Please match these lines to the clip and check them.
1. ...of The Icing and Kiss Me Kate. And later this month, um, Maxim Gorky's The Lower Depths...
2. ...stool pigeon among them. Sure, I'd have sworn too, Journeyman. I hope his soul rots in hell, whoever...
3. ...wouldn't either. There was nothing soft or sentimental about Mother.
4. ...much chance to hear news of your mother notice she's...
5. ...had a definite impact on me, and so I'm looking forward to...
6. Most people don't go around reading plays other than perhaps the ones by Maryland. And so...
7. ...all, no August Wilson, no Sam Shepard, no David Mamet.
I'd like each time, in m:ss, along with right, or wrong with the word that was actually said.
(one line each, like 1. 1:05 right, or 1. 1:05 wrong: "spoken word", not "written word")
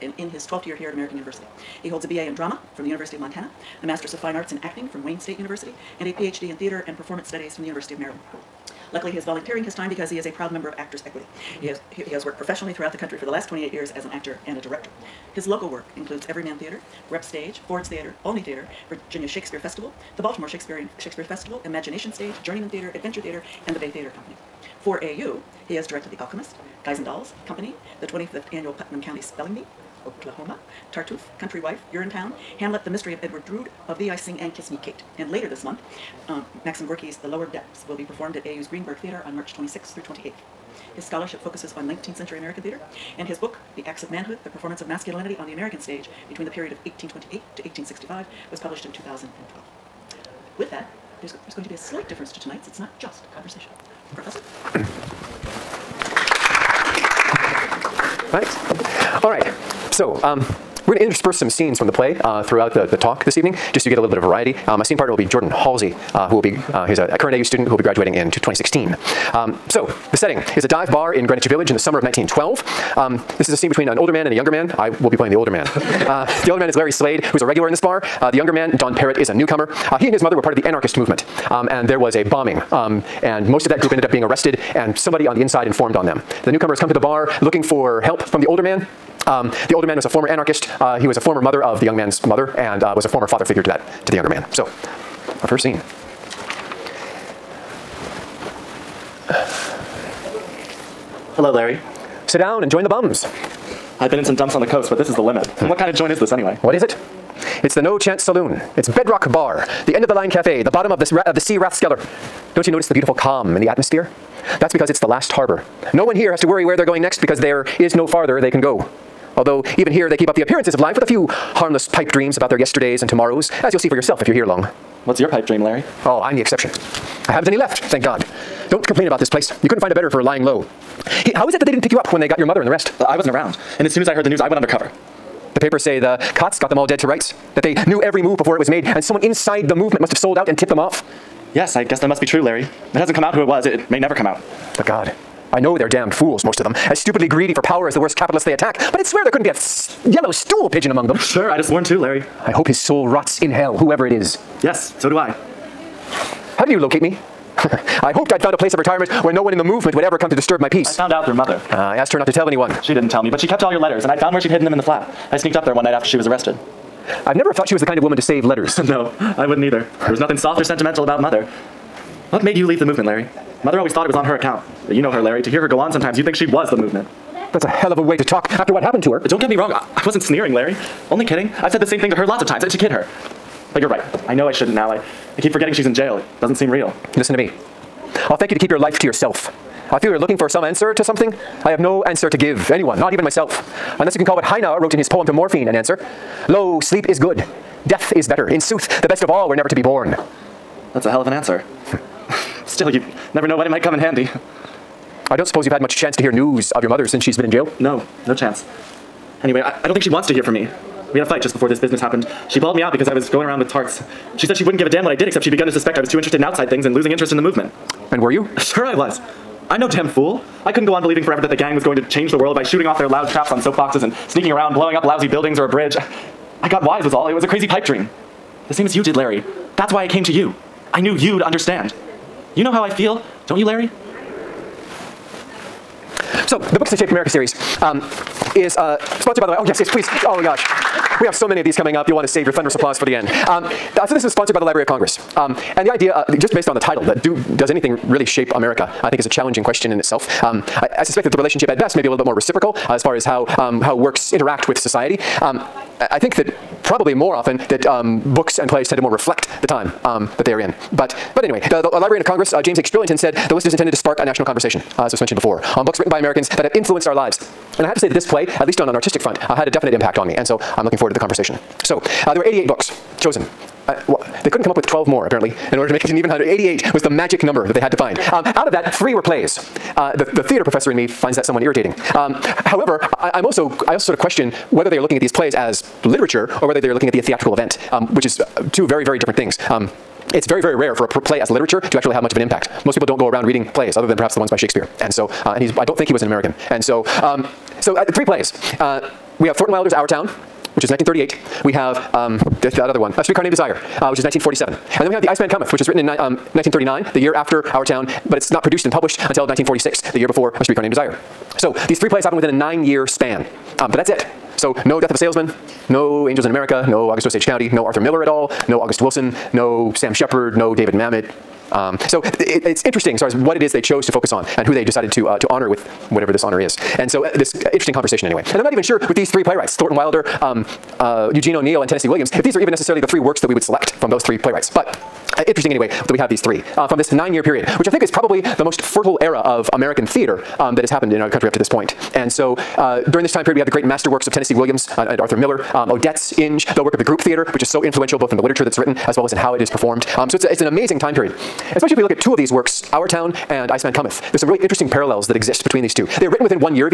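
1. 0:33 right
2. 2:30 wrong: "Larry", not "Journeyman"
3. 2:49 right
4. 3:25 wrong: "since", not "notice"
5. 4:29 right
6. 4:52 wrong: "Shakespeare", not "Maryland"
7. 5:18 right.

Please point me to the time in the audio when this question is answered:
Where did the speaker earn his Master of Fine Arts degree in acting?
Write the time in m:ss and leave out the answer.
0:05.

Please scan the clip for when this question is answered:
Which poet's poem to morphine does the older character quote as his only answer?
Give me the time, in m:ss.
3:14.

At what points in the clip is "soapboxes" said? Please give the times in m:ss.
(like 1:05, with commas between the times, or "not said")
3:43.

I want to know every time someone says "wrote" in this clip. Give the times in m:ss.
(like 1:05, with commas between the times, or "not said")
3:14.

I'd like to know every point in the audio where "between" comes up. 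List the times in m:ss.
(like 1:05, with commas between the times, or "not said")
0:46, 1:13, 5:55.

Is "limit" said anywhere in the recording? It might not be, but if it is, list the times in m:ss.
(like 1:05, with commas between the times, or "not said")
1:45.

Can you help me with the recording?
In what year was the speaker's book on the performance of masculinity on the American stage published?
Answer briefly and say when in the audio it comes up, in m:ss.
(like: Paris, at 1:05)
2012, at 0:48.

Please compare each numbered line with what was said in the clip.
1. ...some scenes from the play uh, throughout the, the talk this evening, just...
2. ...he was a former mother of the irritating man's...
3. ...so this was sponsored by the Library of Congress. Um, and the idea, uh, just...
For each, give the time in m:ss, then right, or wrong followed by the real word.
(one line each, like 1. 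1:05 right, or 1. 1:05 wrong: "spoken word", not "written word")
1. 1:01 right
2. 1:30 wrong: "young", not "irritating"
3. 4:04 right.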